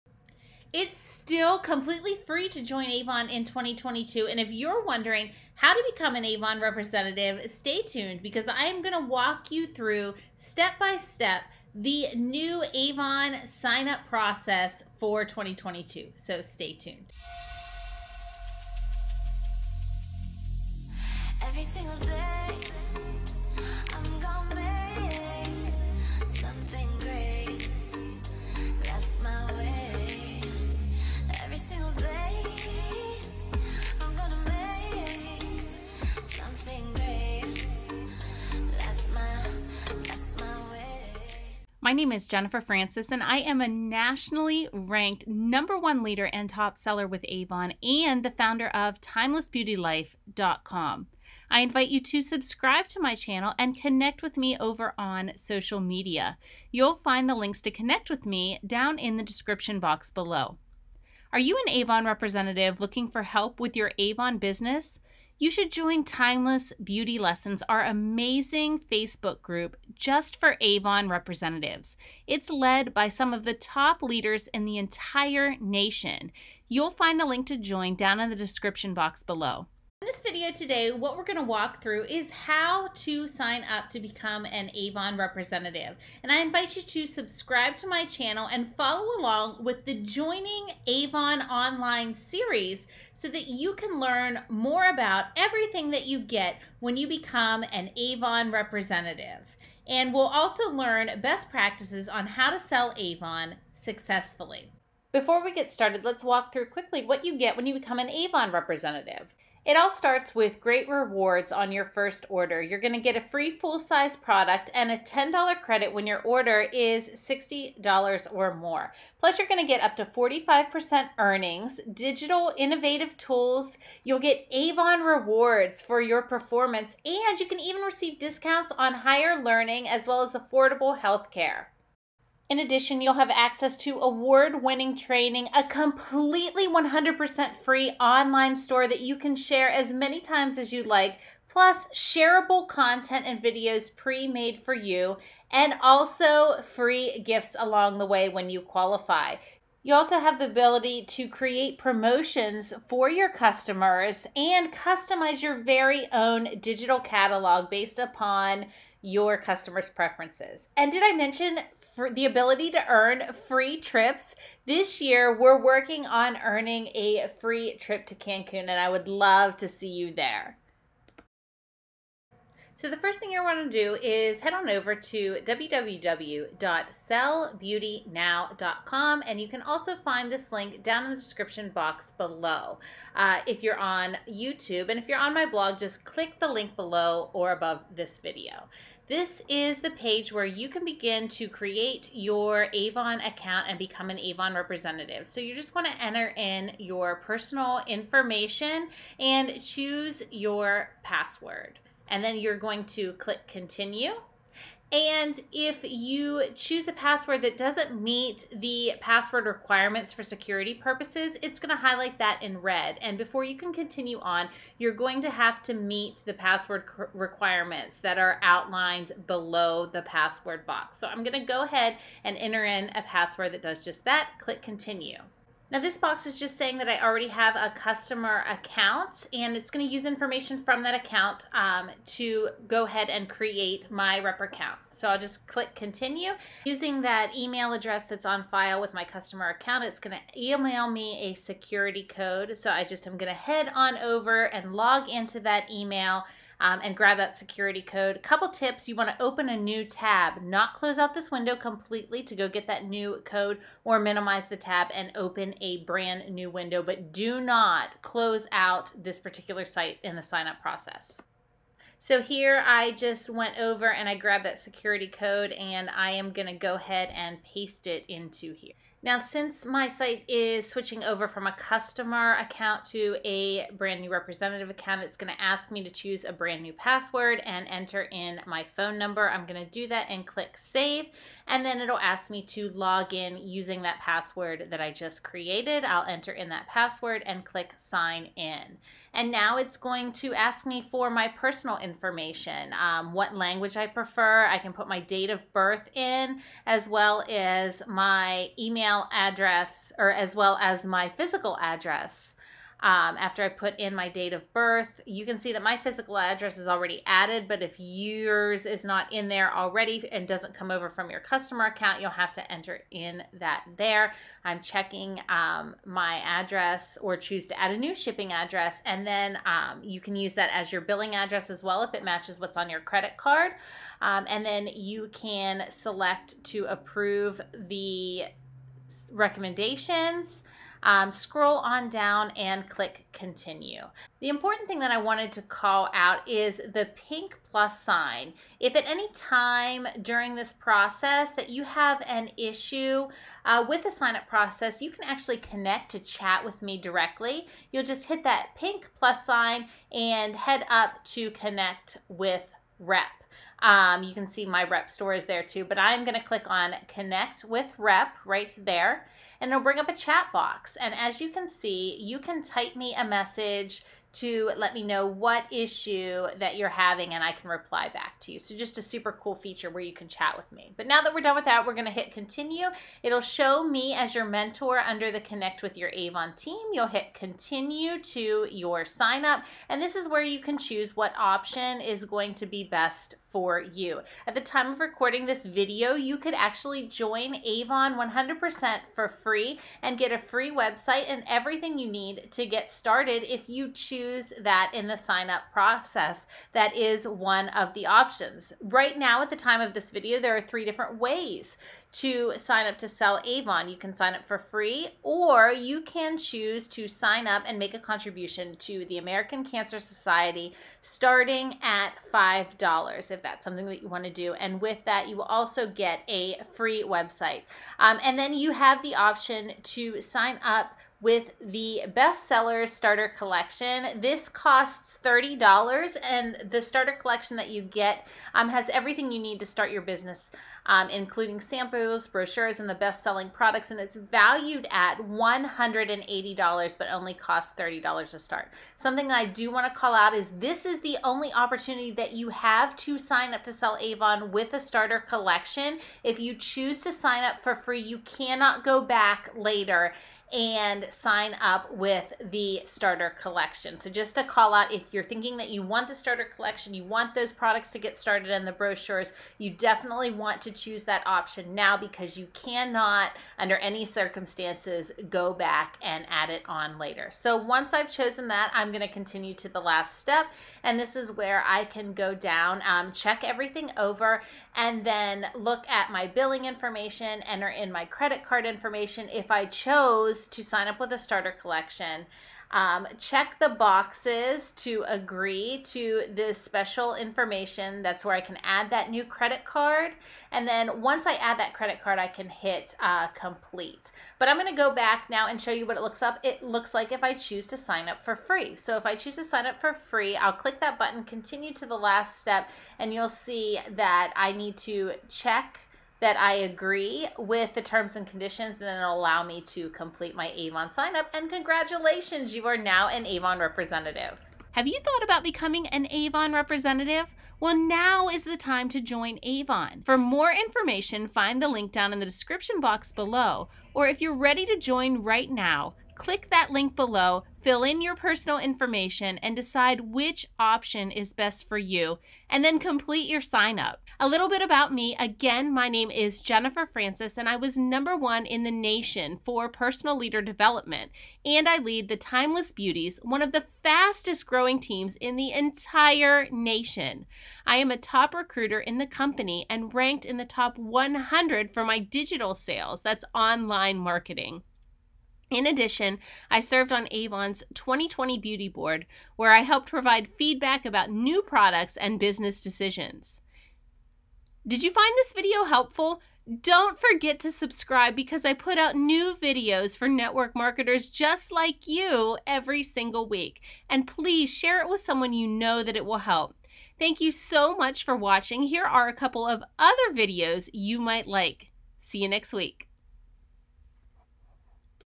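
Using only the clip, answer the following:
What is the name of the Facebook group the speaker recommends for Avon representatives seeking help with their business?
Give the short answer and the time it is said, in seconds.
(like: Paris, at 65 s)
Timeless Beauty Lessons, at 66 s.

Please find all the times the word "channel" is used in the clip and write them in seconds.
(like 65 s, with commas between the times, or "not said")
53 s, 88 s.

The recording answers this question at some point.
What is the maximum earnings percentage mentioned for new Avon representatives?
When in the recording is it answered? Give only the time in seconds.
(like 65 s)
120 s.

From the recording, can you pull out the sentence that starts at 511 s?
And congratulations, you are now an Avon representative.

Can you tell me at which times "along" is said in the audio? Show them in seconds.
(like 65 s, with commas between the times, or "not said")
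89 s, 147 s.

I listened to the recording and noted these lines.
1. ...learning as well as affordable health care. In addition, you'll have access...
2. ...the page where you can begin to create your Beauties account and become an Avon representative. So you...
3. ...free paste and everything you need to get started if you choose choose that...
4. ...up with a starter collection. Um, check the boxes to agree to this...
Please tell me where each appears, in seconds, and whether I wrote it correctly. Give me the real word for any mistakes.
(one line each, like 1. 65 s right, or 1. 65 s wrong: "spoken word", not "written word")
1. 129 s right
2. 189 s wrong: "Avon", not "Beauties"
3. 390 s wrong: "website", not "paste"
4. 480 s right.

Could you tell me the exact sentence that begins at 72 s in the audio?
It's led by some of the top leaders in the entire nation.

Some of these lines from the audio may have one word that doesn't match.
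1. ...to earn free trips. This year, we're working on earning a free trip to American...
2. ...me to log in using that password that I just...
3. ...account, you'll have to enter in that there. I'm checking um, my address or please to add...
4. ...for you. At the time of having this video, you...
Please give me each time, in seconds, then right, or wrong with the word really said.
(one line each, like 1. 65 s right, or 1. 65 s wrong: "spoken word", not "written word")
1. 162 s wrong: "Cancun", not "American"
2. 282 s right
3. 311 s wrong: "choose", not "please"
4. 383 s wrong: "recording", not "having".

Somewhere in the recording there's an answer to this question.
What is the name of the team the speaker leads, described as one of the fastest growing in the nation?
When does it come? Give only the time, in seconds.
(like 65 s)
541 s.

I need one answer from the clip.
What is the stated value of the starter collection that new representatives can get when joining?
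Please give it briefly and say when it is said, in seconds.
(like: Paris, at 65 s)
$180, at 434 s.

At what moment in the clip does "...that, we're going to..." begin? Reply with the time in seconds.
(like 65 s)
371 s.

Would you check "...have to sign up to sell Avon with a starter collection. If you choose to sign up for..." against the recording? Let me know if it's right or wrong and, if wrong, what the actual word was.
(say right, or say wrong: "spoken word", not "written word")
right.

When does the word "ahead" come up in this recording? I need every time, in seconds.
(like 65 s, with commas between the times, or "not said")
221 s, 232 s, 266 s.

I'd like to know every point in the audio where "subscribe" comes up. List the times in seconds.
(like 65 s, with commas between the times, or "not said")
52 s, 87 s, 567 s.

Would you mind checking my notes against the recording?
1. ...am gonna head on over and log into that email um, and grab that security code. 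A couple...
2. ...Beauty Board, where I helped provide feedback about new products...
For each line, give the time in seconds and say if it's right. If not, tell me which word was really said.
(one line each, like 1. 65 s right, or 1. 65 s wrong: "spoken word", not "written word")
1. 243 s right
2. 558 s right.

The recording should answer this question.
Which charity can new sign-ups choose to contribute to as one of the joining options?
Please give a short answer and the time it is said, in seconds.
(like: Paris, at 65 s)
American Cancer Society, at 408 s.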